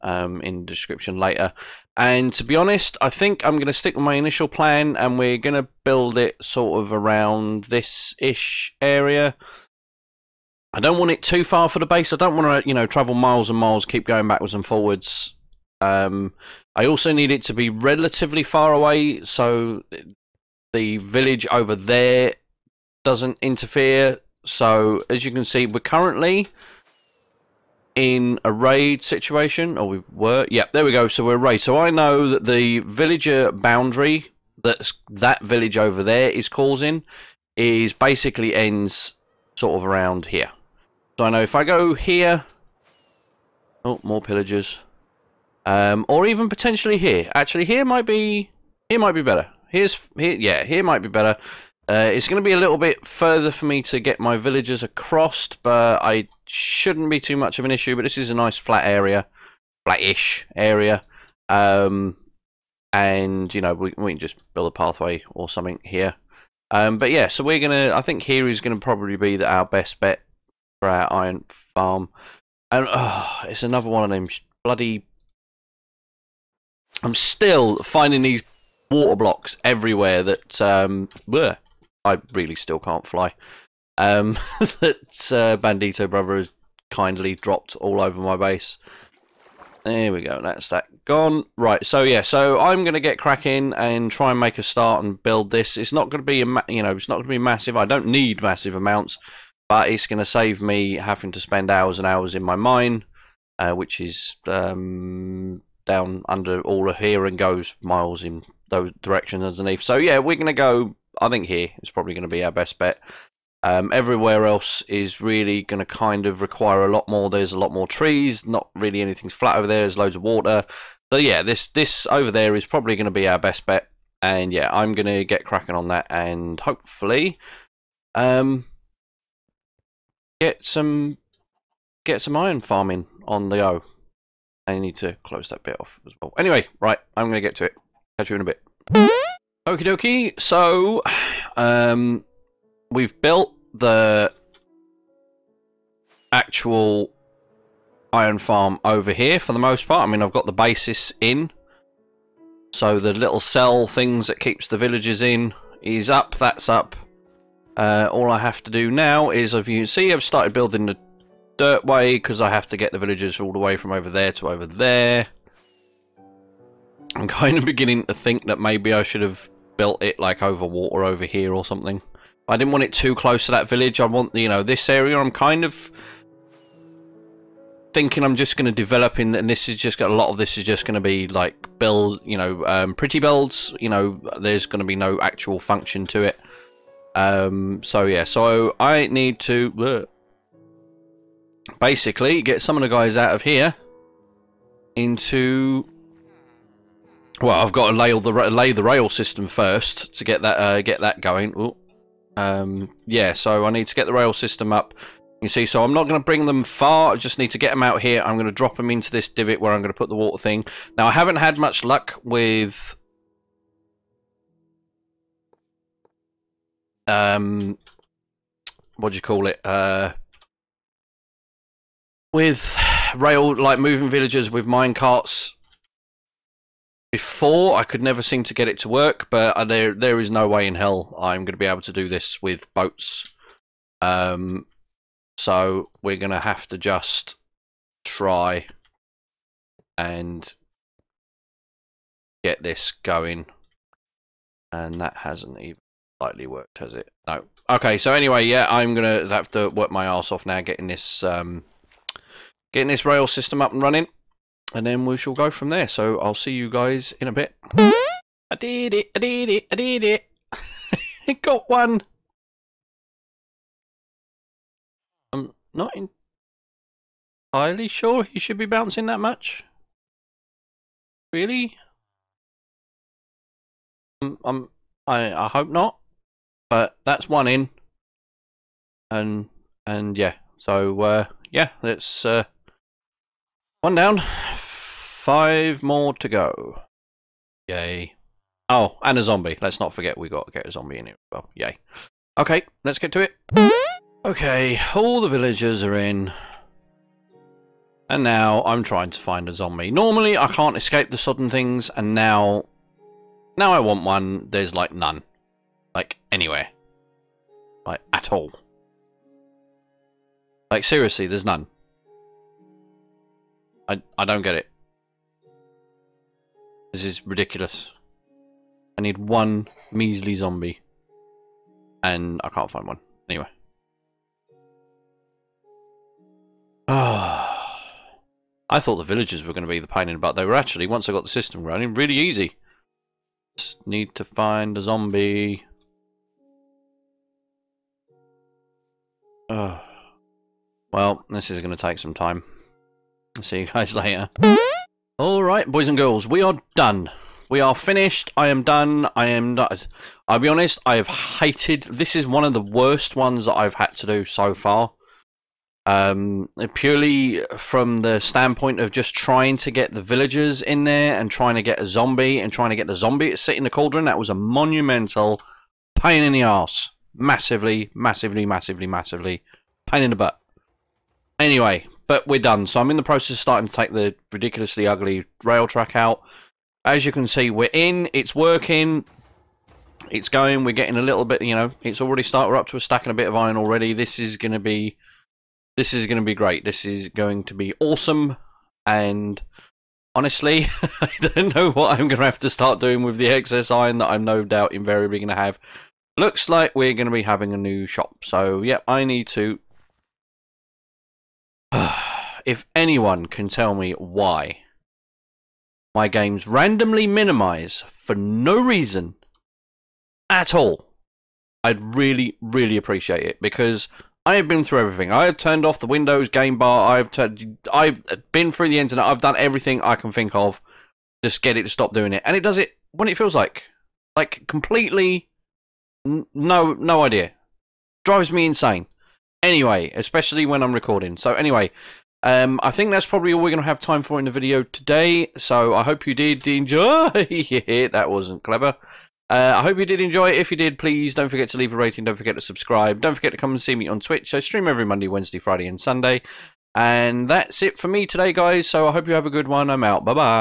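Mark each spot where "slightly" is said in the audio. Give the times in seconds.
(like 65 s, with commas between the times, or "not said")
246 s.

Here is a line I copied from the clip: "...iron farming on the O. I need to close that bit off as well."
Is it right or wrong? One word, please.
right.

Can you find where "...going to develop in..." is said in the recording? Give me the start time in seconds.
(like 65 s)
178 s.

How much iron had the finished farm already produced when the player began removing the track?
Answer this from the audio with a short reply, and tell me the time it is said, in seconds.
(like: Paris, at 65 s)
A stack and a bit, at 382 s.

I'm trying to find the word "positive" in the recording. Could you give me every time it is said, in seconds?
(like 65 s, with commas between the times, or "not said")
not said.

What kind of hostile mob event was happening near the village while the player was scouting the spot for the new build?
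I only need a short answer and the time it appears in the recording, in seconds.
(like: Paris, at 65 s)
A raid, at 28 s.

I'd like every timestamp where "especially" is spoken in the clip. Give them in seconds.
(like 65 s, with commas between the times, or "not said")
429 s.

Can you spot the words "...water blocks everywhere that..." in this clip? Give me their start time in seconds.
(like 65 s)
78 s.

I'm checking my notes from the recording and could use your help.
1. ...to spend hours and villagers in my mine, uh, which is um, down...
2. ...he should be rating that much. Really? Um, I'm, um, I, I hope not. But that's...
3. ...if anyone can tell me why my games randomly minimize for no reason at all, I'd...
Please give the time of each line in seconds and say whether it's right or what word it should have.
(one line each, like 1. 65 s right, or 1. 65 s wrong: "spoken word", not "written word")
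1. 101 s wrong: "hours", not "villagers"
2. 268 s wrong: "bouncing", not "rating"
3. 402 s right.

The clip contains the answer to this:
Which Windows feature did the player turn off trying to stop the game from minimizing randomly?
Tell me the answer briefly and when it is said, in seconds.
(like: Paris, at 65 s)
Windows game bar, at 415 s.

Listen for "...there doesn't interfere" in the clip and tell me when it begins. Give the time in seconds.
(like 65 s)
21 s.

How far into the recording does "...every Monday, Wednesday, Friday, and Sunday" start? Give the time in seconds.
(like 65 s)
444 s.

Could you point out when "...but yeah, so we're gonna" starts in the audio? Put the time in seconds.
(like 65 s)
66 s.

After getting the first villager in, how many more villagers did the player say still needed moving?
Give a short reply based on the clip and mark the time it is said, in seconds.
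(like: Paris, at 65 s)
5, at 284 s.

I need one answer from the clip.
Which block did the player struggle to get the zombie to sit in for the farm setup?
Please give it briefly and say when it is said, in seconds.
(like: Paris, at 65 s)
Cauldron, at 363 s.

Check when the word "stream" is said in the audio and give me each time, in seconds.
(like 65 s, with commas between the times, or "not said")
444 s.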